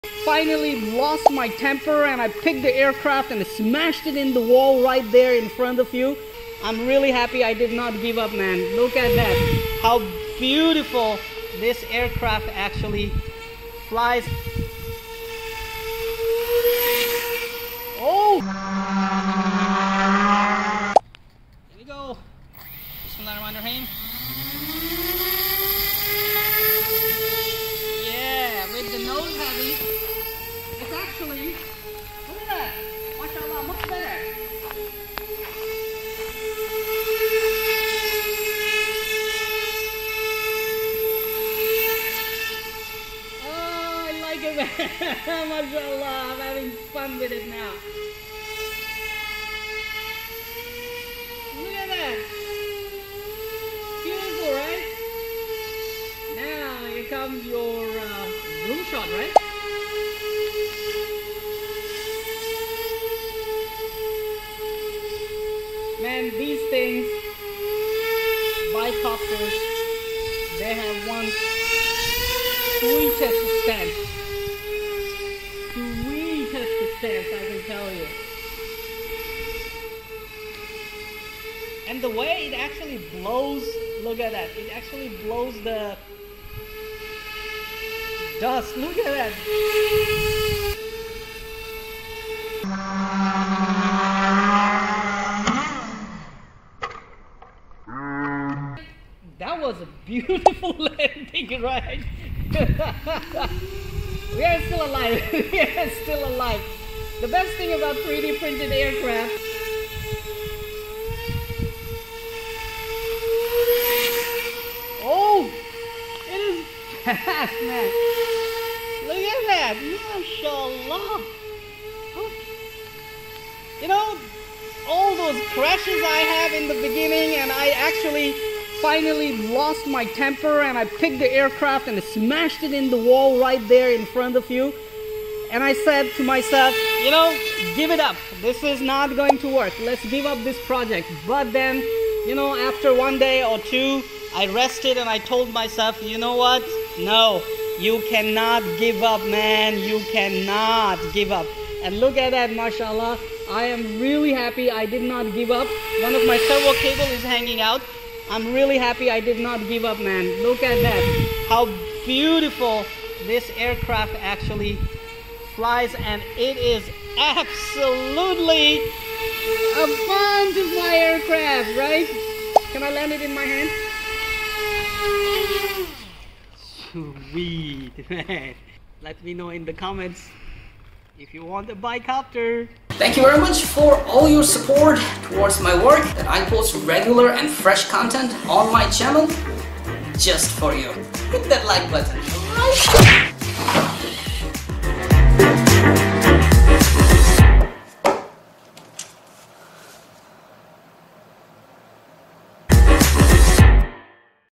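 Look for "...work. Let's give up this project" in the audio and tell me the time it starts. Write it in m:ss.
2:19.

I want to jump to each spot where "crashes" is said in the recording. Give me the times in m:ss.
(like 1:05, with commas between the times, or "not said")
2:05.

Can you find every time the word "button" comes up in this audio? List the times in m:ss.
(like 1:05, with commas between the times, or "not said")
3:11.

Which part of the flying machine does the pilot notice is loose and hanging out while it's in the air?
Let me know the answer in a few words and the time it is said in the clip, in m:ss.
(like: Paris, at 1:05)
servo cable, at 2:36.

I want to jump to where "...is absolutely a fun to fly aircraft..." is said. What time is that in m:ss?
2:46.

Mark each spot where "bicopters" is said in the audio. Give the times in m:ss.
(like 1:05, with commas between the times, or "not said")
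1:08, 3:02.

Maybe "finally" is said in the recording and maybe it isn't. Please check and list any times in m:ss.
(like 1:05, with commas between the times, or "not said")
0:00, 2:08.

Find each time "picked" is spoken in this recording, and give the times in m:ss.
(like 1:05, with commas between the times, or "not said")
0:02, 2:10.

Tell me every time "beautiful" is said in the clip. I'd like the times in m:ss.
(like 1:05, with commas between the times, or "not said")
0:10, 0:54, 1:40, 2:42.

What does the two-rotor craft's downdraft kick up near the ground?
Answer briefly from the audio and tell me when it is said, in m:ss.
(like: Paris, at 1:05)
dust, at 1:28.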